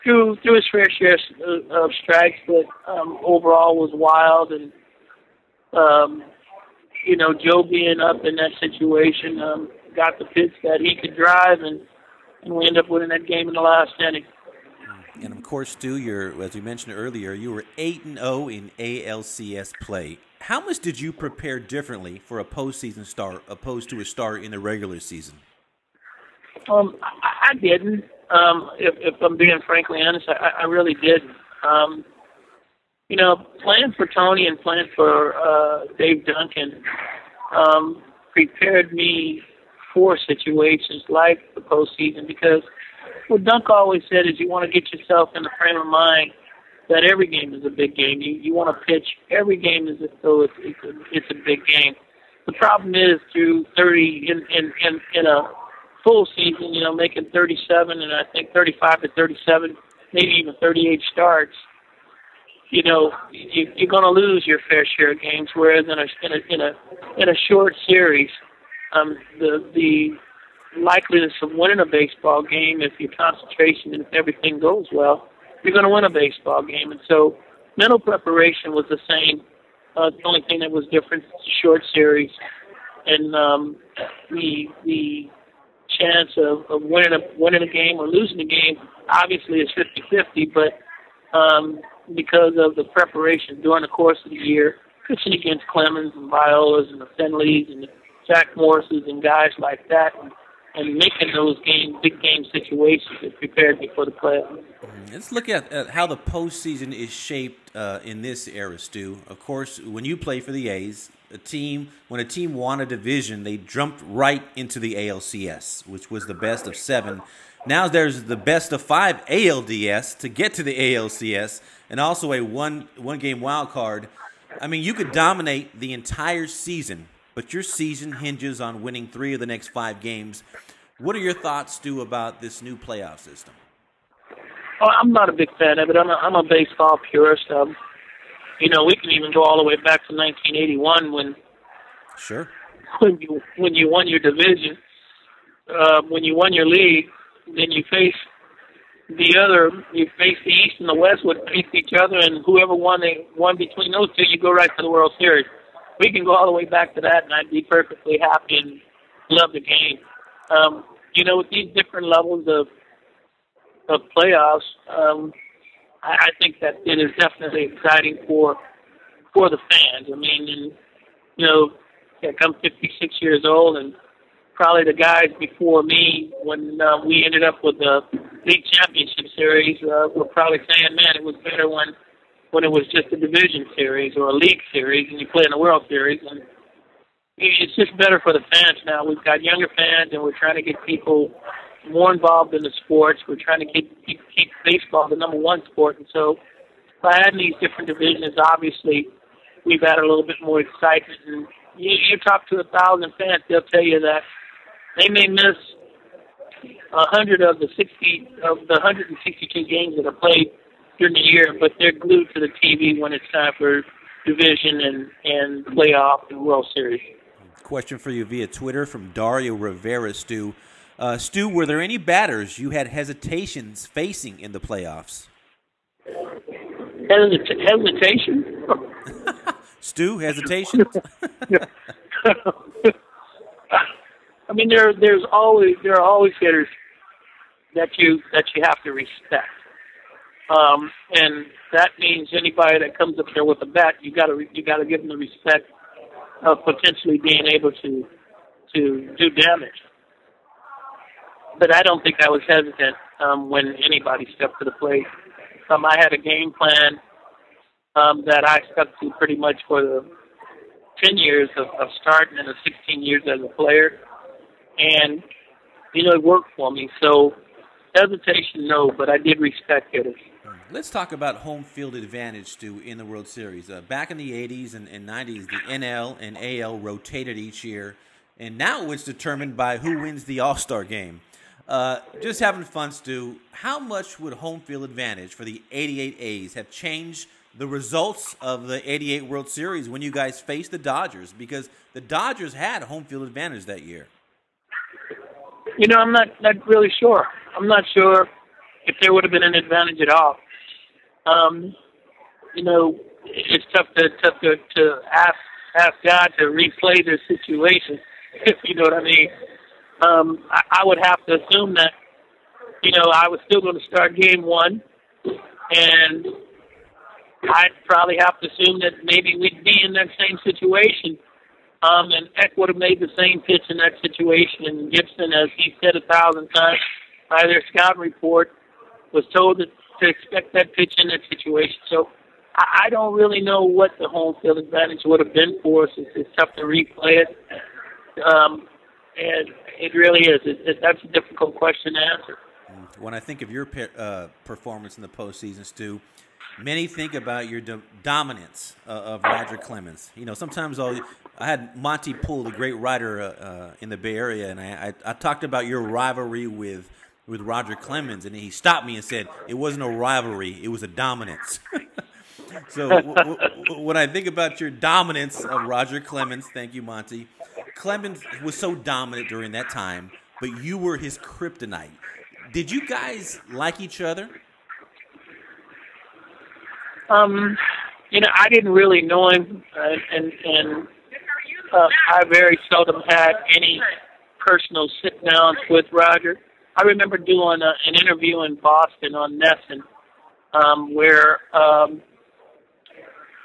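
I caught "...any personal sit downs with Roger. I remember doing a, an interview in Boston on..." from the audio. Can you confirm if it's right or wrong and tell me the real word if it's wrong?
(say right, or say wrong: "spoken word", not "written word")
right.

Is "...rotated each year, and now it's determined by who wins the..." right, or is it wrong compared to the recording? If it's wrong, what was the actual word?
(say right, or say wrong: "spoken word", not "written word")
right.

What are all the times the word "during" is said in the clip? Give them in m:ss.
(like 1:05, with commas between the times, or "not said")
1:33, 3:31, 6:09.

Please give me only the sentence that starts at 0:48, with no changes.
You you want to pitch every game as though it's it's a, it's a big game.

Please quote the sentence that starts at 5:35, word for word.
It's, it's tough to replay it.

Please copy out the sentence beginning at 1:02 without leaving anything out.
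You know, you, you're going to lose your fair share of games.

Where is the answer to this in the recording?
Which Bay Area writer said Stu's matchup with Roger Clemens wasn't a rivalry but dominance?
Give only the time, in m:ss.
5:51.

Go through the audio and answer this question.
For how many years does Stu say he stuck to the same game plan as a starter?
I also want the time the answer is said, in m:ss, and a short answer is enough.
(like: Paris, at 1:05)
10, at 4:21.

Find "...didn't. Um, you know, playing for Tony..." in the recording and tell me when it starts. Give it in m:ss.
0:30.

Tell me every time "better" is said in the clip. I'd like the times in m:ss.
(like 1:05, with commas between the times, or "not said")
3:01, 3:07.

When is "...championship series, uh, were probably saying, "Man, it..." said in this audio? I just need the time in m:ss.
2:58.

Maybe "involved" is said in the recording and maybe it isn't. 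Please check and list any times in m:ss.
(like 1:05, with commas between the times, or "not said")
3:12.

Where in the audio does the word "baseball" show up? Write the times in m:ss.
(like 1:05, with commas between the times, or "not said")
1:11, 1:16, 2:16, 3:14.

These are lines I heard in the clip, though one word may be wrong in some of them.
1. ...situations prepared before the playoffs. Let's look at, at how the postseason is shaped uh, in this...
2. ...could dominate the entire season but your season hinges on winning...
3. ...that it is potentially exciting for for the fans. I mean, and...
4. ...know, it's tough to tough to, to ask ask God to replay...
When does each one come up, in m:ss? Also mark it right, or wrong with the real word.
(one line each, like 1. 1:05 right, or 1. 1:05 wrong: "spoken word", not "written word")
1. 1:42 right
2. 2:04 right
3. 2:46 wrong: "definitely", not "potentially"
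4. 5:02 right.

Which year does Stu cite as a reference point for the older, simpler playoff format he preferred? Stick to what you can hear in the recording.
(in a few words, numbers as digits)
1981.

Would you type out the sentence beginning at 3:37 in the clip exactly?
Question for you via Twitter from Dario Rivera, Stu.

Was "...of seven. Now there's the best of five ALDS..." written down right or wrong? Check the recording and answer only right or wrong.
right.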